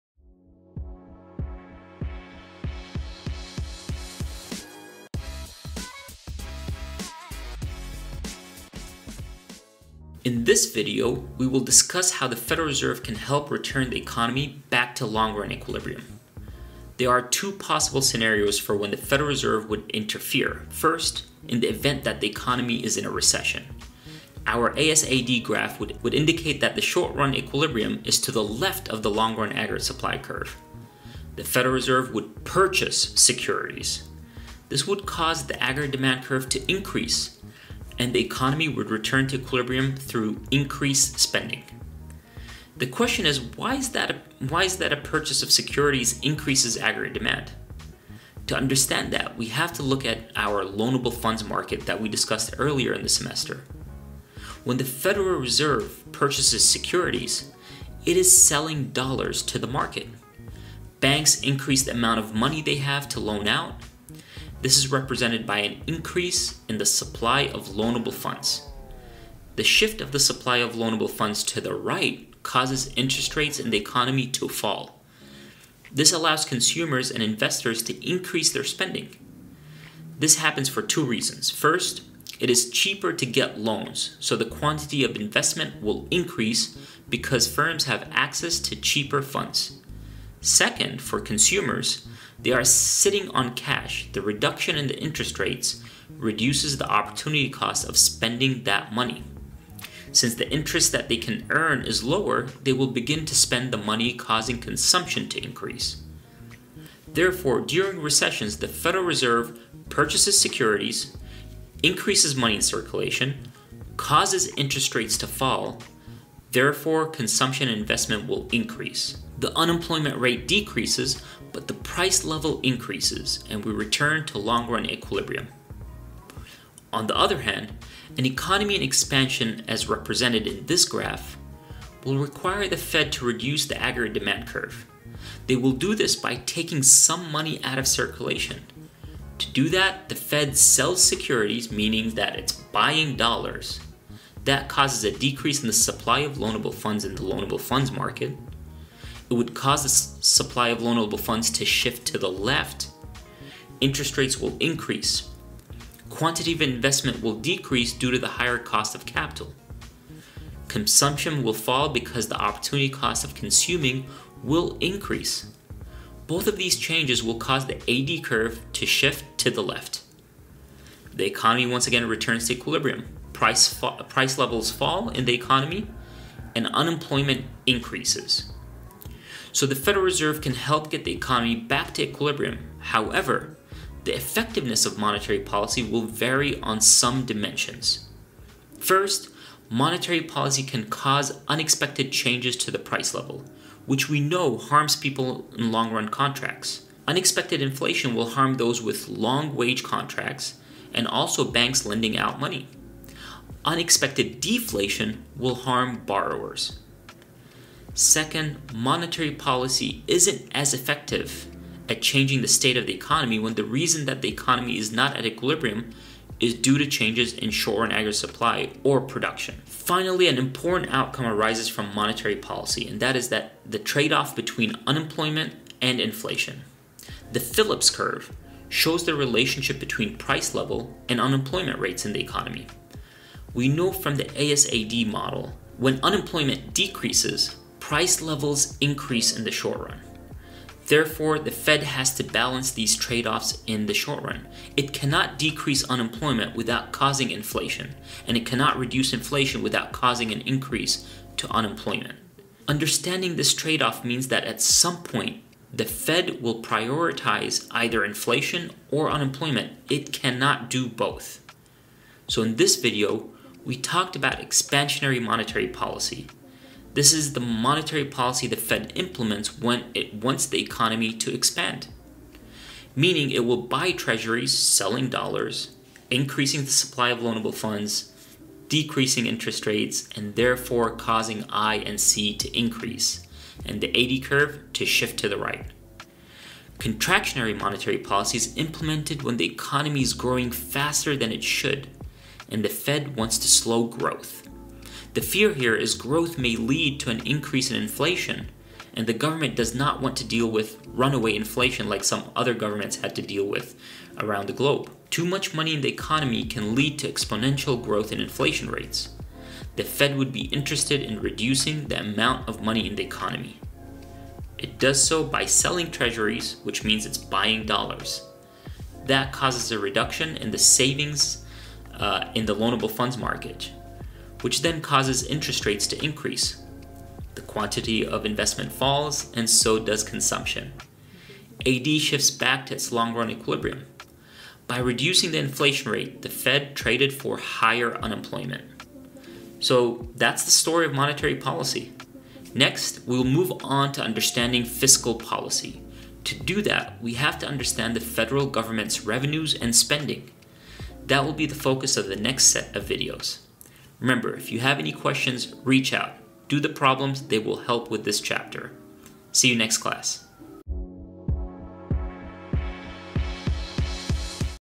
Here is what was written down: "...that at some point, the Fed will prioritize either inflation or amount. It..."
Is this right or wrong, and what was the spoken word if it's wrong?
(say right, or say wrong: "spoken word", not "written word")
wrong: "unemployment", not "amount".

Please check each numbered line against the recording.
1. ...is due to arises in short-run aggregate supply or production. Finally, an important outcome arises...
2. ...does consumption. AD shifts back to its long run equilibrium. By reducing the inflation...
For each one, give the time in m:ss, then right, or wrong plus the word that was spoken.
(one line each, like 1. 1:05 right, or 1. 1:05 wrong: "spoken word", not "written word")
1. 3:36 wrong: "changes", not "arises"
2. 5:29 right.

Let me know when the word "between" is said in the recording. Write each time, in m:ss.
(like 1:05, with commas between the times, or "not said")
3:44, 3:49.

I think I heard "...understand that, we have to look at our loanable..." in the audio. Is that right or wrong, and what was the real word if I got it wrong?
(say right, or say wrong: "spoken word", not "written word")
right.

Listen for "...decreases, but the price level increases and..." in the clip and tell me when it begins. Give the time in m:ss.
2:00.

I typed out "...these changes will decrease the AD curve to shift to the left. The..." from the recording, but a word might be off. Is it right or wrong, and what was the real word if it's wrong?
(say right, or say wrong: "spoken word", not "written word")
wrong: "cause", not "decrease".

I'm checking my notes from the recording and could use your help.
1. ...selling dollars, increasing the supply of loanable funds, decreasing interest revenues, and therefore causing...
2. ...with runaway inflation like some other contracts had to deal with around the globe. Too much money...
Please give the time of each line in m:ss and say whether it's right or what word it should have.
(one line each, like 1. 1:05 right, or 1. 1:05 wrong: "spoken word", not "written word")
1. 4:34 wrong: "rates", not "revenues"
2. 5:00 wrong: "governments", not "contracts".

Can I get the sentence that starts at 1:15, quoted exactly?
This allows consumers and investors to increase their spending.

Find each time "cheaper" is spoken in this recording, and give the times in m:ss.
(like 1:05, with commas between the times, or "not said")
1:22, 1:28.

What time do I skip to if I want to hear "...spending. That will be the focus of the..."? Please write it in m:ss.
5:49.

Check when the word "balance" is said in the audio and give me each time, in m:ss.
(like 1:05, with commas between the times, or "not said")
4:02.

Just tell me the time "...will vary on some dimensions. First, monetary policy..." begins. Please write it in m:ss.
3:05.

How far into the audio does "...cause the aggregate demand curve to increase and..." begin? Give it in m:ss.
0:35.